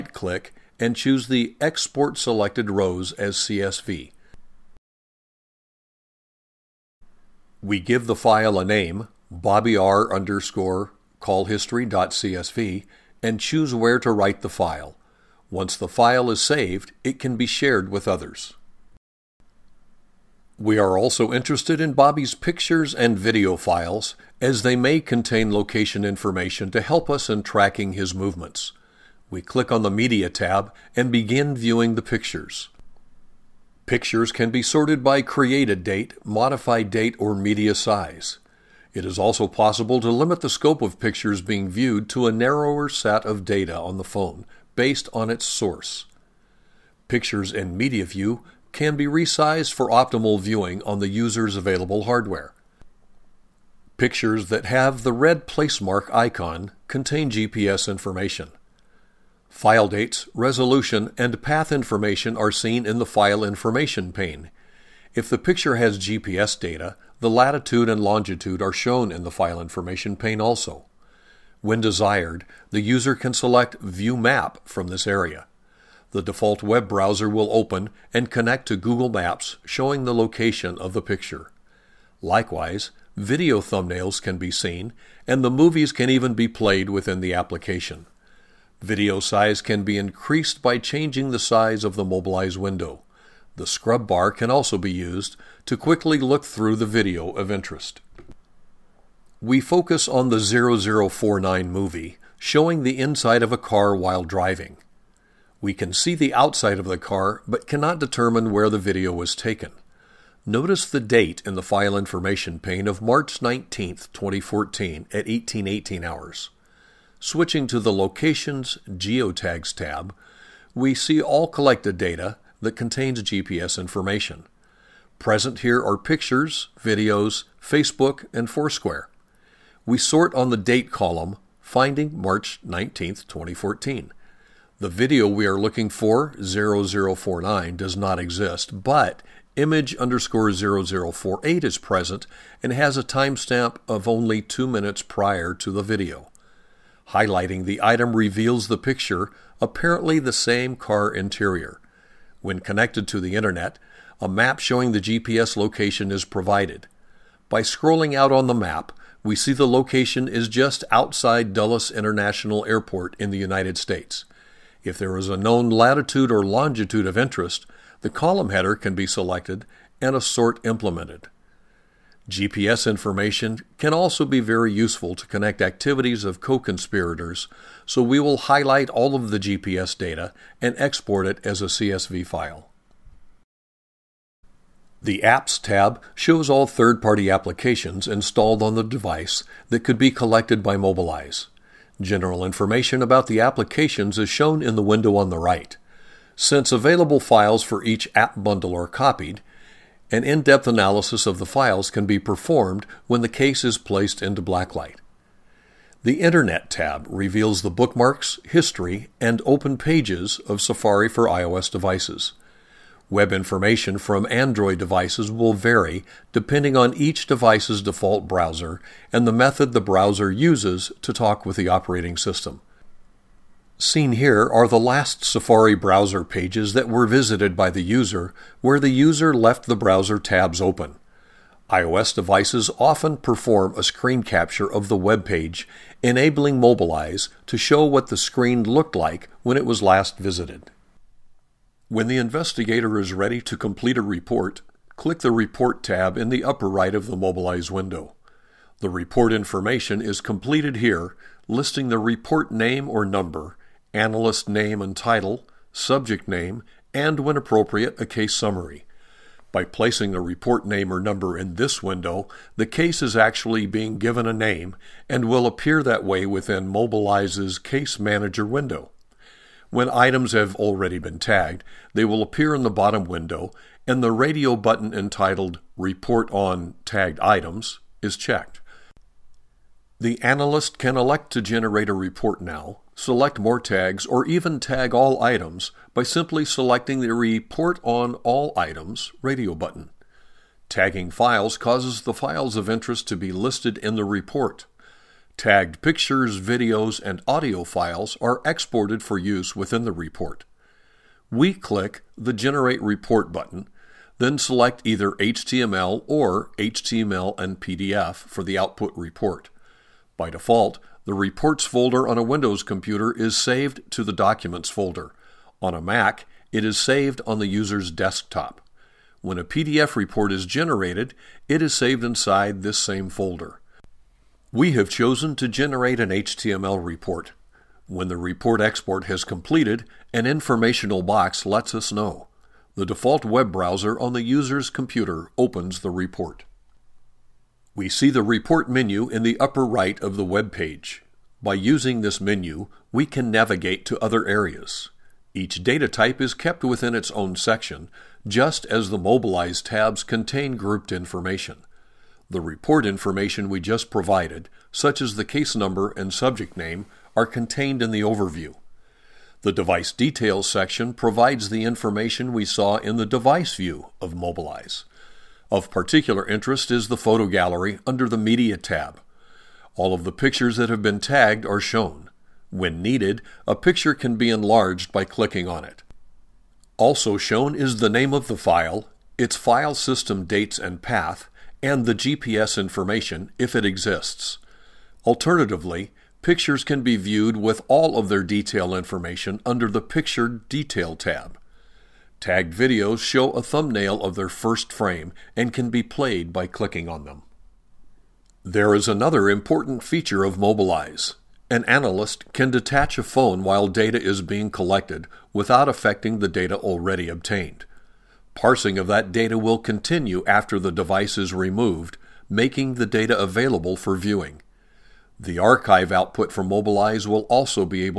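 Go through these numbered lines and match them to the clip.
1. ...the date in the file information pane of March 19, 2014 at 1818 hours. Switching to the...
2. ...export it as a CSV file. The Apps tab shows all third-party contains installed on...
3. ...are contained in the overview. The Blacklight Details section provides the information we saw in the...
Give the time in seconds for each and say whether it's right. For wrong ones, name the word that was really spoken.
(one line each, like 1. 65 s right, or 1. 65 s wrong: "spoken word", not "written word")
1. 110 s right
2. 180 s wrong: "applications", not "contains"
3. 357 s wrong: "Device", not "Blacklight".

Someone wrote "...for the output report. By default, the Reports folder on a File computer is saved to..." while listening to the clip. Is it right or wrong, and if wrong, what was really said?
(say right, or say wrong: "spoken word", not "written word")
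wrong: "Windows", not "File".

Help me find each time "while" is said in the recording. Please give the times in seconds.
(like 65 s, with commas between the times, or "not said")
103 s, 403 s.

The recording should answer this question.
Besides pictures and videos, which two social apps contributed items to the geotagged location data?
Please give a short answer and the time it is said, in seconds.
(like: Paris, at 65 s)
Facebook and Foursquare, at 127 s.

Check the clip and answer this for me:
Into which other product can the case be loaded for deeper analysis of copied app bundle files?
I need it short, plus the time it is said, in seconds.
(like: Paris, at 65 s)
Blacklight, at 204 s.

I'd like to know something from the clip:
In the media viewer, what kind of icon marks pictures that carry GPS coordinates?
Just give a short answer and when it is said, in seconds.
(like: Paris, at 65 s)
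red placemark icon, at 55 s.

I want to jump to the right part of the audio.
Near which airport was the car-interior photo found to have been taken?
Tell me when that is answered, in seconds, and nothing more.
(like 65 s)
161 s.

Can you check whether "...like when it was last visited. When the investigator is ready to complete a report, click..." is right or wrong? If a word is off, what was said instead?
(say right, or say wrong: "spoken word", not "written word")
right.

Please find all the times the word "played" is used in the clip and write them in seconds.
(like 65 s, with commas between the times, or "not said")
86 s, 395 s.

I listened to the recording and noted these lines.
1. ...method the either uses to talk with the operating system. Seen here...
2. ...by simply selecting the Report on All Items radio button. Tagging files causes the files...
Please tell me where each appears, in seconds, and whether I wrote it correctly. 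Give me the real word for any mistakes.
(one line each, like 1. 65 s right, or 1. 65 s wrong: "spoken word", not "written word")
1. 219 s wrong: "browser", not "either"
2. 285 s right.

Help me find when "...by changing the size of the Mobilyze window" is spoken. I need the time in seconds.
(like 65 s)
90 s.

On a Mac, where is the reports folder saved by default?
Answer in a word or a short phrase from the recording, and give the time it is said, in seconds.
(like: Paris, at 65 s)
user's desktop, at 317 s.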